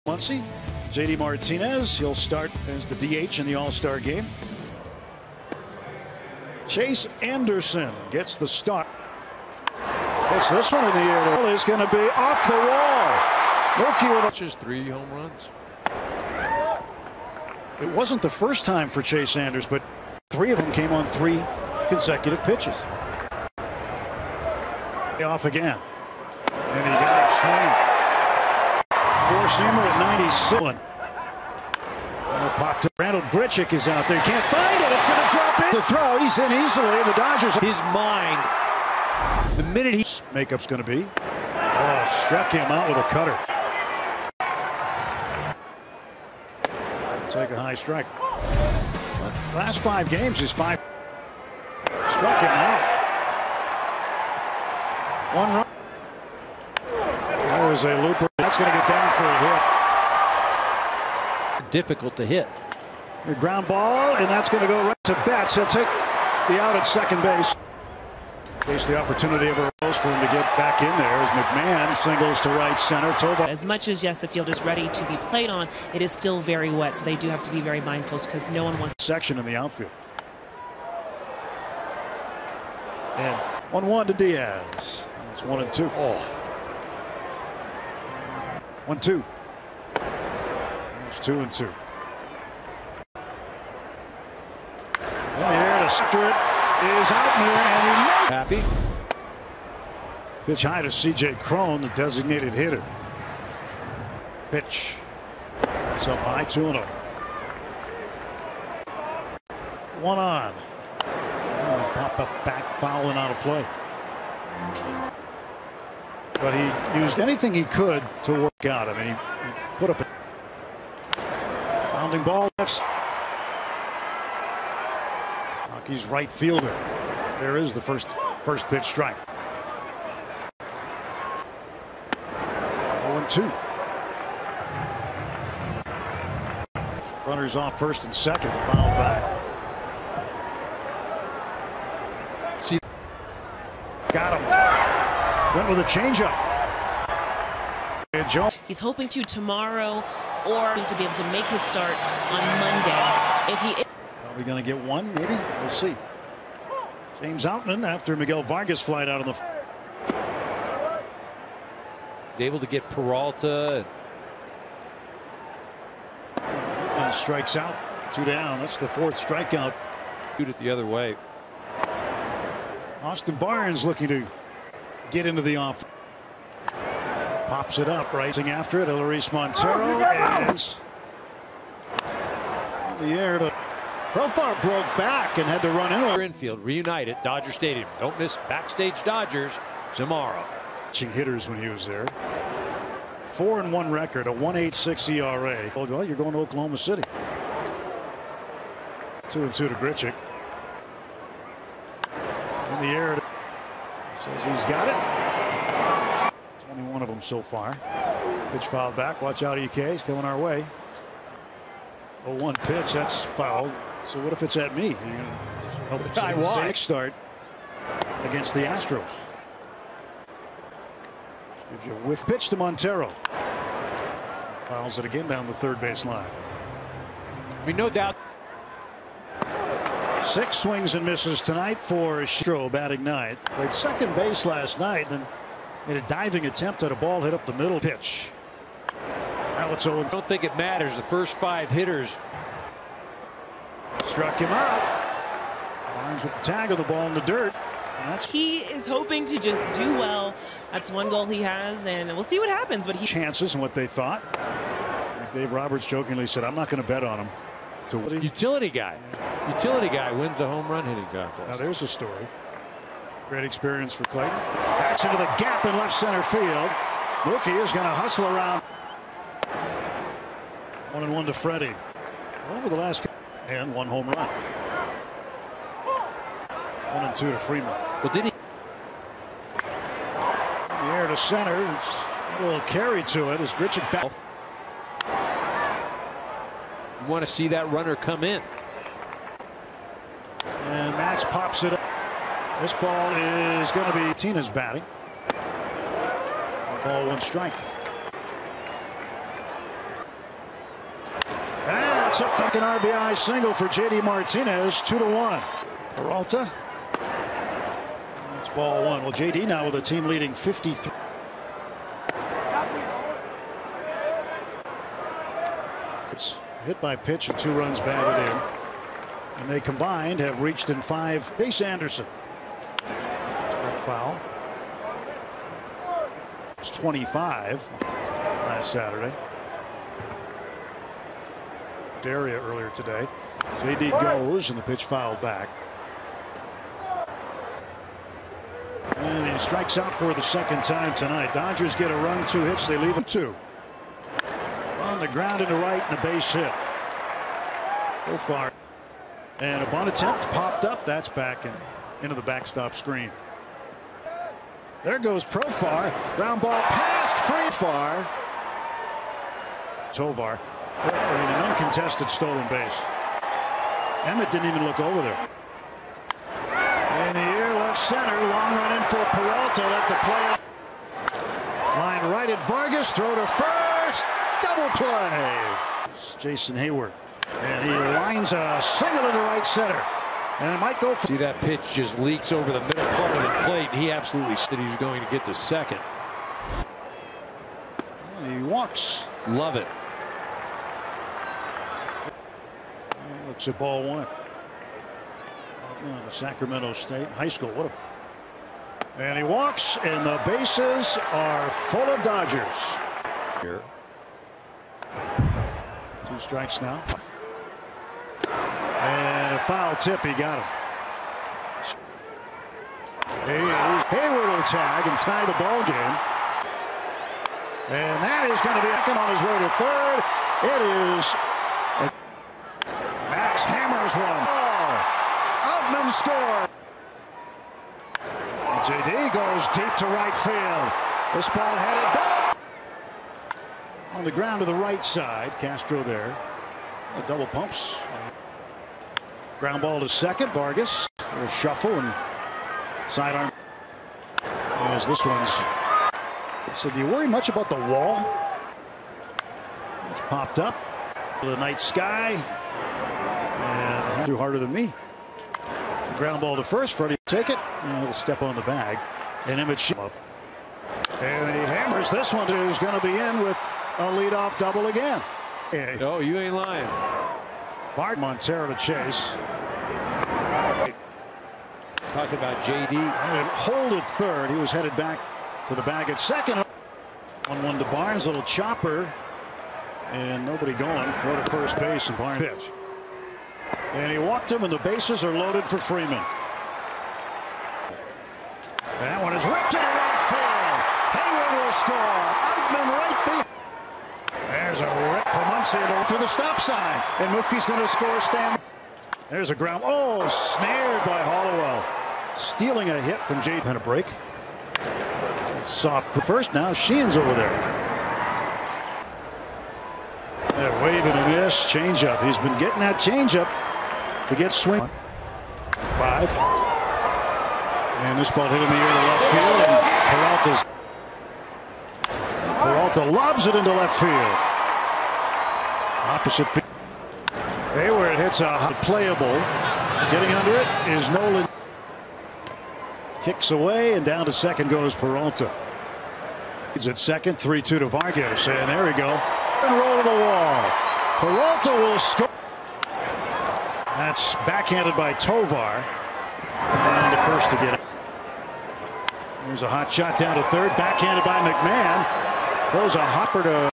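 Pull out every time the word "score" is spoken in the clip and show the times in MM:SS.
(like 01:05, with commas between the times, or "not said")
07:05, 08:13, 08:17, 09:01.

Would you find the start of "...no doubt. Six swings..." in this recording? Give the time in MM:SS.
03:47.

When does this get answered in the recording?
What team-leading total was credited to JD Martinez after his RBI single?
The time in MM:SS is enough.
05:10.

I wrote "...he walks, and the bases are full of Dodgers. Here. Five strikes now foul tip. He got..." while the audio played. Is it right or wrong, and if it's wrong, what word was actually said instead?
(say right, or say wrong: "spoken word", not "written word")
wrong: "Two", not "Five".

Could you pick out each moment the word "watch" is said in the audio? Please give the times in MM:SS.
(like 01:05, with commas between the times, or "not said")
03:29, 03:36.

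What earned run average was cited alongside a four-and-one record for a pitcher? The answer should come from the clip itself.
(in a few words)
1.86.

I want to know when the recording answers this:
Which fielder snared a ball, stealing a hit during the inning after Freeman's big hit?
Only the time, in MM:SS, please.
08:21.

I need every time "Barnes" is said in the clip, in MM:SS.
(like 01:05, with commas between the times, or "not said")
02:53, 04:05, 07:57, 08:01.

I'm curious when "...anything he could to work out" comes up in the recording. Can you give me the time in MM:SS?
01:57.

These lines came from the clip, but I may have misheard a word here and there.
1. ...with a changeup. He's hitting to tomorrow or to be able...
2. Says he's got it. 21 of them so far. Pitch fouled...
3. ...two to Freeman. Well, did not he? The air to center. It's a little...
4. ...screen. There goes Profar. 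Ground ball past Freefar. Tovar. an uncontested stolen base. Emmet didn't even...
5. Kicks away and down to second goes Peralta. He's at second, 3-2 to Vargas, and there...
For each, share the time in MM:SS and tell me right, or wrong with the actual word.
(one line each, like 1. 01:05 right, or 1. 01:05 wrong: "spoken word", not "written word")
1. 02:25 wrong: "hoping", not "hitting"
2. 03:24 right
3. 04:37 right
4. 05:52 right
5. 08:53 right.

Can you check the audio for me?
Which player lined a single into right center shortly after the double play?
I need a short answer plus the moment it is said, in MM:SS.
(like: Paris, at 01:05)
Jason Heyward, at 06:16.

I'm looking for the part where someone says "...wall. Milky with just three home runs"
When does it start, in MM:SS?
00:12.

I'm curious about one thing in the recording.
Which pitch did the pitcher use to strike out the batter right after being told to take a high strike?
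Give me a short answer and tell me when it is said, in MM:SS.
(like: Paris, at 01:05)
cutter, at 00:43.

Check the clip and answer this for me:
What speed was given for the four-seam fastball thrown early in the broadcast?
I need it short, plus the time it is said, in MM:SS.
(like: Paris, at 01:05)
97, at 00:30.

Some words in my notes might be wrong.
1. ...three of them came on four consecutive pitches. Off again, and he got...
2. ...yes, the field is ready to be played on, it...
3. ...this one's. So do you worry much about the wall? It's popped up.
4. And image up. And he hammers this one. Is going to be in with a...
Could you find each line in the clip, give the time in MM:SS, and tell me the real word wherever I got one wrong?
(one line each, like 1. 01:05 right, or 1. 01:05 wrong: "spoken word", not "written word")
1. 00:20 wrong: "three", not "four"
2. 01:14 right
3. 07:24 right
4. 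07:39 right.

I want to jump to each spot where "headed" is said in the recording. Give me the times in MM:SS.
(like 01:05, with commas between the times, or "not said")
07:11, 07:54.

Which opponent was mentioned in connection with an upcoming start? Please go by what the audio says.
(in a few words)
Astros.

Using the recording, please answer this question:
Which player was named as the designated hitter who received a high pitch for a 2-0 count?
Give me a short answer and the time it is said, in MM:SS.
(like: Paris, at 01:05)
C.J. Cron, at 01:40.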